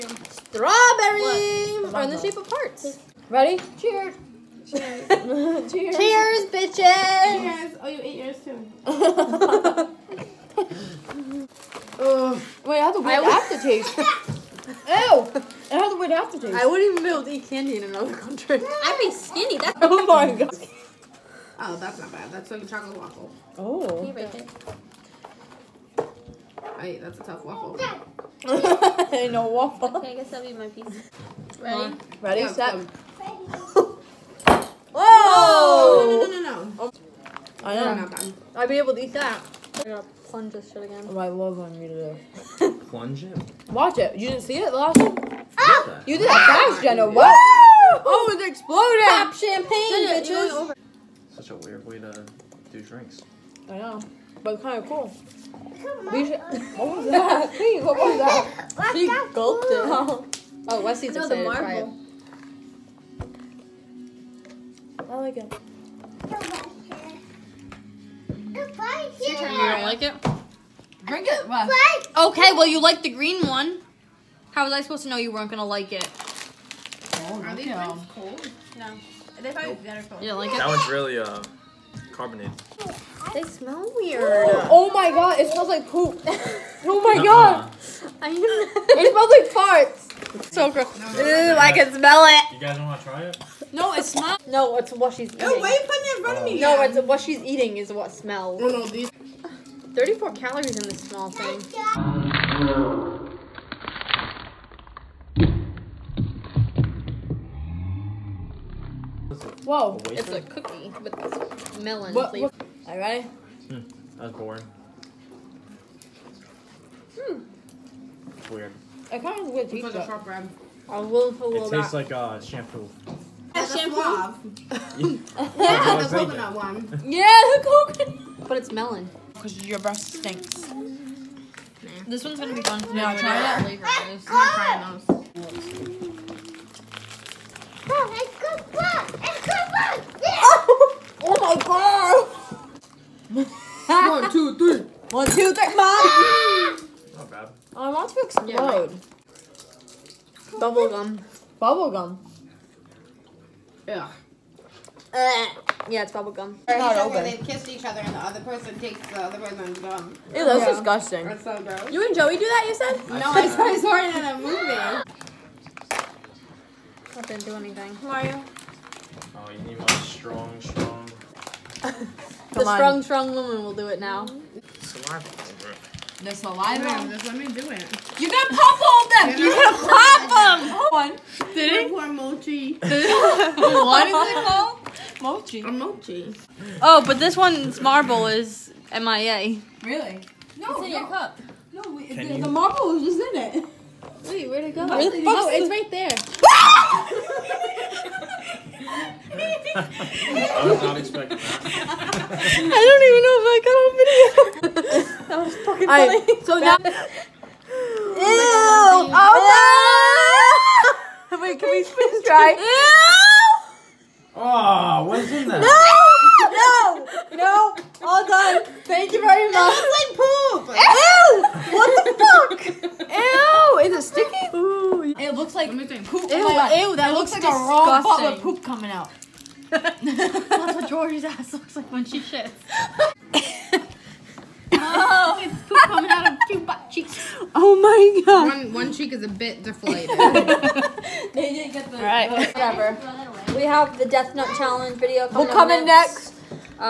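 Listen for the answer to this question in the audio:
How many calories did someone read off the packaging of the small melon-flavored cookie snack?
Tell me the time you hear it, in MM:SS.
01:39.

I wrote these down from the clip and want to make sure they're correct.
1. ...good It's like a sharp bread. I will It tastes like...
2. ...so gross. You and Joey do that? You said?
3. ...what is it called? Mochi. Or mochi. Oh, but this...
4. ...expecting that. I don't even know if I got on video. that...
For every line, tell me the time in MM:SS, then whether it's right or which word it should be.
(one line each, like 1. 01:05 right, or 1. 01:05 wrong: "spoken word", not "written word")
1. 01:59 right
2. 02:41 right
3. 03:02 right
4. 03:20 right.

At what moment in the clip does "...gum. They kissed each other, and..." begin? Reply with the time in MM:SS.
02:36.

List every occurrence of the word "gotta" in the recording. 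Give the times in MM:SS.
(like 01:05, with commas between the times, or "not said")
00:39, 02:59.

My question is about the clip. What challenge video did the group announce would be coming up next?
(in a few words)
Death Nut Challenge.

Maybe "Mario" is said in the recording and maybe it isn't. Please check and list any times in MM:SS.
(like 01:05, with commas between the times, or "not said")
02:48.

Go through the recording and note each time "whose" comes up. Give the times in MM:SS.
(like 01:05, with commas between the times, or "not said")
not said.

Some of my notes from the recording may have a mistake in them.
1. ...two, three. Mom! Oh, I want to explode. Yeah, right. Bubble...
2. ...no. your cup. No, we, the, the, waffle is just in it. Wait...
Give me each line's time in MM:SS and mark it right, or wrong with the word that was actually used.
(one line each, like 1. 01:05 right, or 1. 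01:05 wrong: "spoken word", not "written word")
1. 02:25 right
2. 03:10 wrong: "marble", not "waffle".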